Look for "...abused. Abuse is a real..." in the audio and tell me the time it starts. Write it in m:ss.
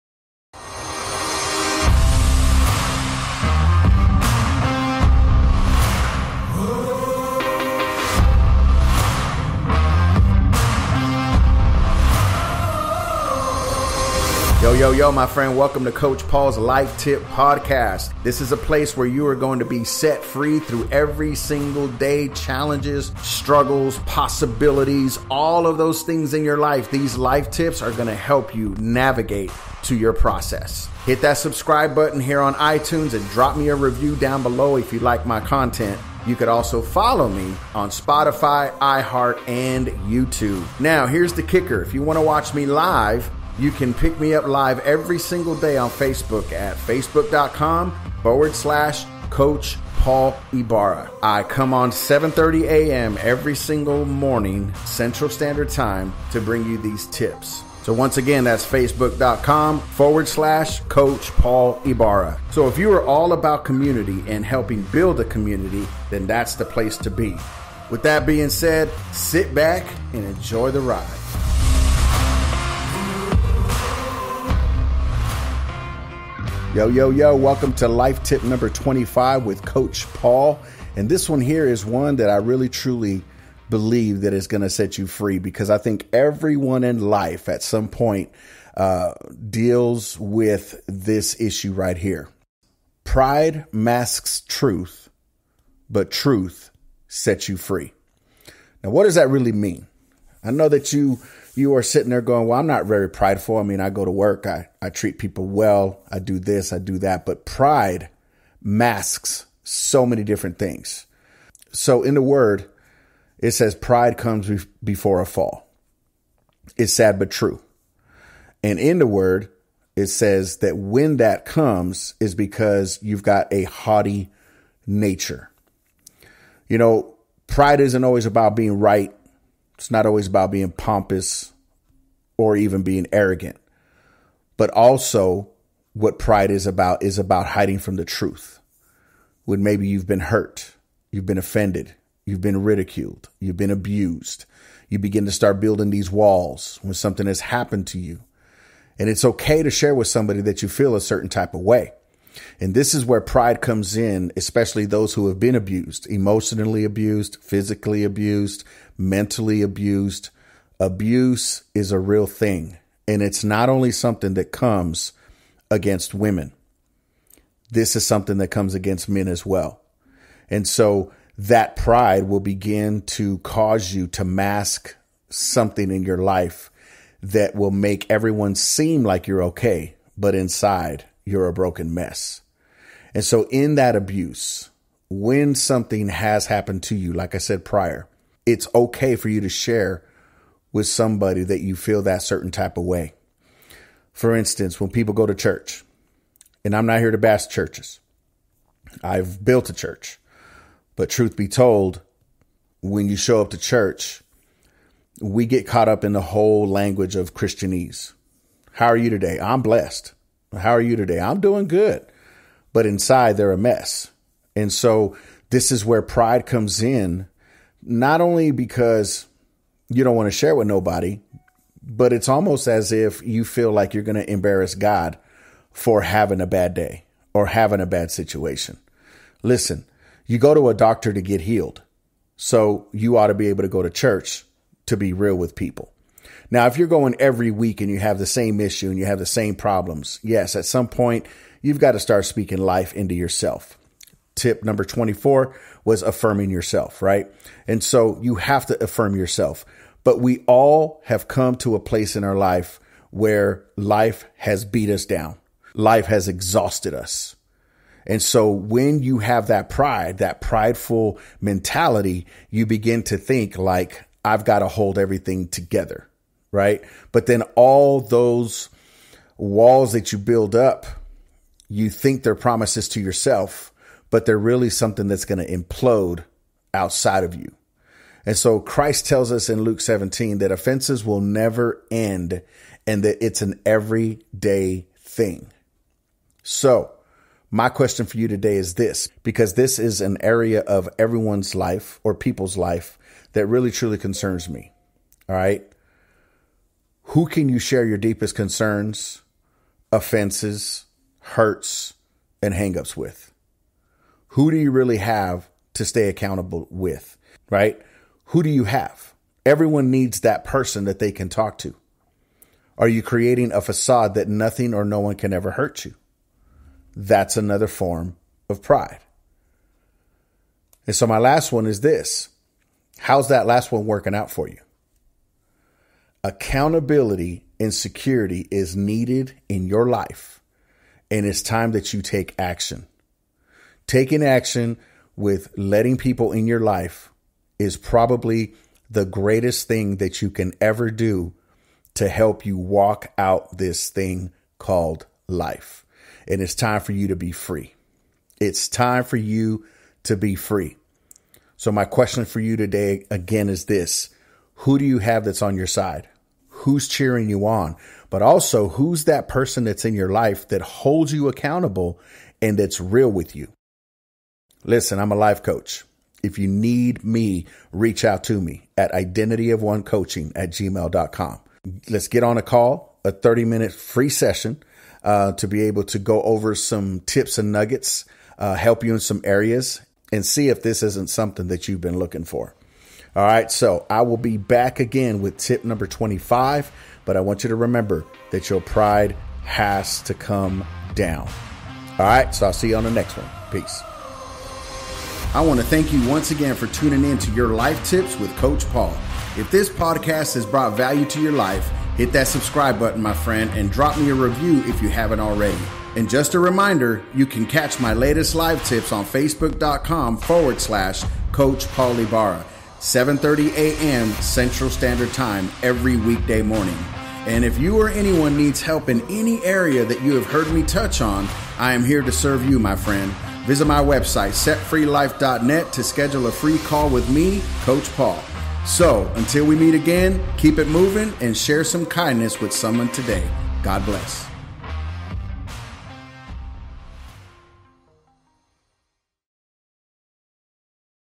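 2:39.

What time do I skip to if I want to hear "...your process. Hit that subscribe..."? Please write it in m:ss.
0:29.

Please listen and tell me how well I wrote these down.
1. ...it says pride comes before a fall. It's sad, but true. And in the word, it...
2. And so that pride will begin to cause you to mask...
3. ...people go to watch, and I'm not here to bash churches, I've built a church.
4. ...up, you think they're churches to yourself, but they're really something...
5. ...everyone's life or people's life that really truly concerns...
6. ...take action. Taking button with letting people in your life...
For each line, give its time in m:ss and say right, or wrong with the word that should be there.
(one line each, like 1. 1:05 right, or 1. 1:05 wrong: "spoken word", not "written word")
1. 1:53 right
2. 2:50 right
3. 3:14 wrong: "church", not "watch"
4. 4:30 wrong: "promises", not "churches"
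5. 4:50 right
6. 5:32 wrong: "action", not "button".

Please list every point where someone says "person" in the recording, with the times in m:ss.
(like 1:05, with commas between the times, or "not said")
5:10, 5:59.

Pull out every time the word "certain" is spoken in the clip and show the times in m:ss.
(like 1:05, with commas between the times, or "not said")
2:31, 3:12.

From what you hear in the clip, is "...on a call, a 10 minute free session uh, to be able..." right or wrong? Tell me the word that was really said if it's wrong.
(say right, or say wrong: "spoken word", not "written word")
wrong: "30", not "10".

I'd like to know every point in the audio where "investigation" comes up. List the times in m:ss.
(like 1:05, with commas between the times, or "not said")
not said.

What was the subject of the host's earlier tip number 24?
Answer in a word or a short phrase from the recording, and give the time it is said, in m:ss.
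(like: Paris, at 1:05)
affirming yourself, at 4:06.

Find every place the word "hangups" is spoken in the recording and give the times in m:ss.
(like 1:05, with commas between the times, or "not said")
5:02.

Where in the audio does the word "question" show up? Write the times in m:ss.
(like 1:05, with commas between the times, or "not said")
4:47, 5:51.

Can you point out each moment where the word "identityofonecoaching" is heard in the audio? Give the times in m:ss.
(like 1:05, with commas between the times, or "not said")
6:08.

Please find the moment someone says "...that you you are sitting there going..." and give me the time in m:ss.
1:40.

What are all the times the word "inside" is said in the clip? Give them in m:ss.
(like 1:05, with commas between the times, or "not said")
3:00, 3:32.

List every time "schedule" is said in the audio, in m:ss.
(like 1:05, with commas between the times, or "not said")
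7:05.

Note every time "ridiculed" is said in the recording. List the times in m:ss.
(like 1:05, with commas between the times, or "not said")
2:22.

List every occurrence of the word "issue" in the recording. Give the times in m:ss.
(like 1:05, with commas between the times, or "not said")
1:31, 3:58.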